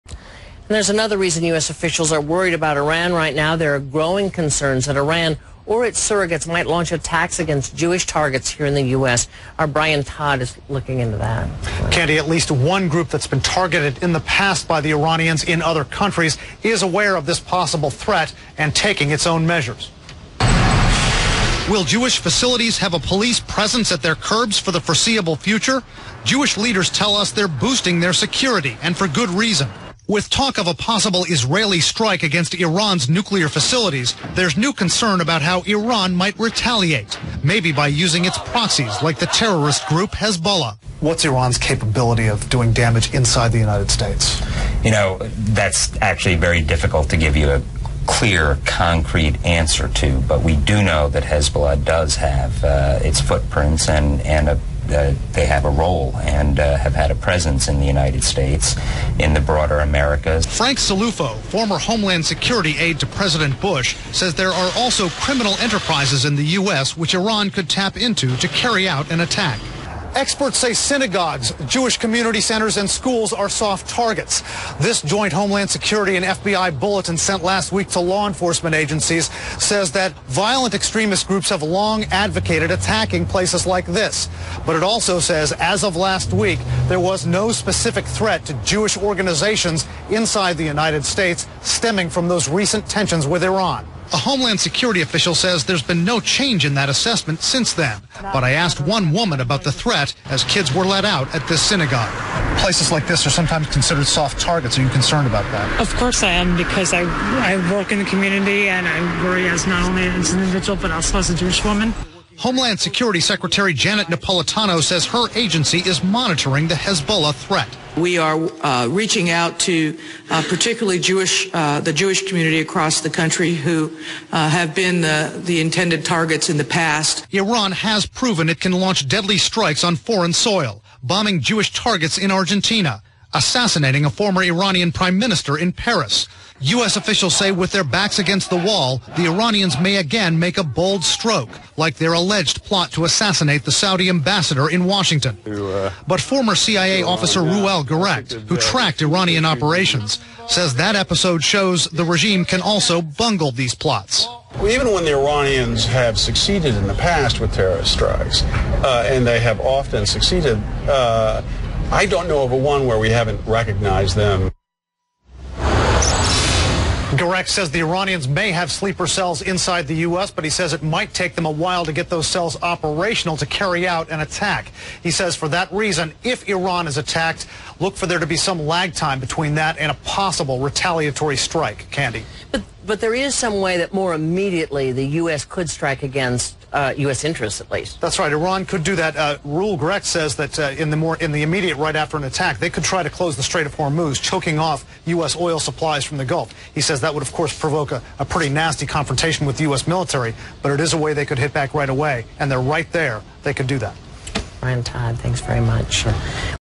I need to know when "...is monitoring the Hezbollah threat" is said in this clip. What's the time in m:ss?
1:55.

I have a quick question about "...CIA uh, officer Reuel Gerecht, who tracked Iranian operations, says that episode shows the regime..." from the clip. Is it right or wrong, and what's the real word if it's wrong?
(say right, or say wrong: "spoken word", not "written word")
right.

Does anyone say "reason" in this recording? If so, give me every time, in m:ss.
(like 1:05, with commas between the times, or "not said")
0:01, 0:29, 2:55.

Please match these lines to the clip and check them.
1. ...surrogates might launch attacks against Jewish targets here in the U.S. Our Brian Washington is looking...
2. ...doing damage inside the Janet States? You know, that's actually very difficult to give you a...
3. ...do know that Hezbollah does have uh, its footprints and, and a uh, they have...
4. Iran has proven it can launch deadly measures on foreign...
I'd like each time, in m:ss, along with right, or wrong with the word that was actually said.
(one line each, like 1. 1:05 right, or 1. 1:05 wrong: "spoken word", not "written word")
1. 0:05 wrong: "Todd", not "Washington"
2. 0:42 wrong: "United", not "Janet"
3. 0:50 right
4. 2:07 wrong: "strikes", not "measures".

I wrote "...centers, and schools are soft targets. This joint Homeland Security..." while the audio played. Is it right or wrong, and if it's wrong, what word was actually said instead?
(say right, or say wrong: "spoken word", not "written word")
right.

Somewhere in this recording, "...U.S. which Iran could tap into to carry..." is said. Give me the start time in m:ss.
1:06.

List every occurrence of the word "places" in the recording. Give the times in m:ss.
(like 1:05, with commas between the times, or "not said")
1:23, 1:42.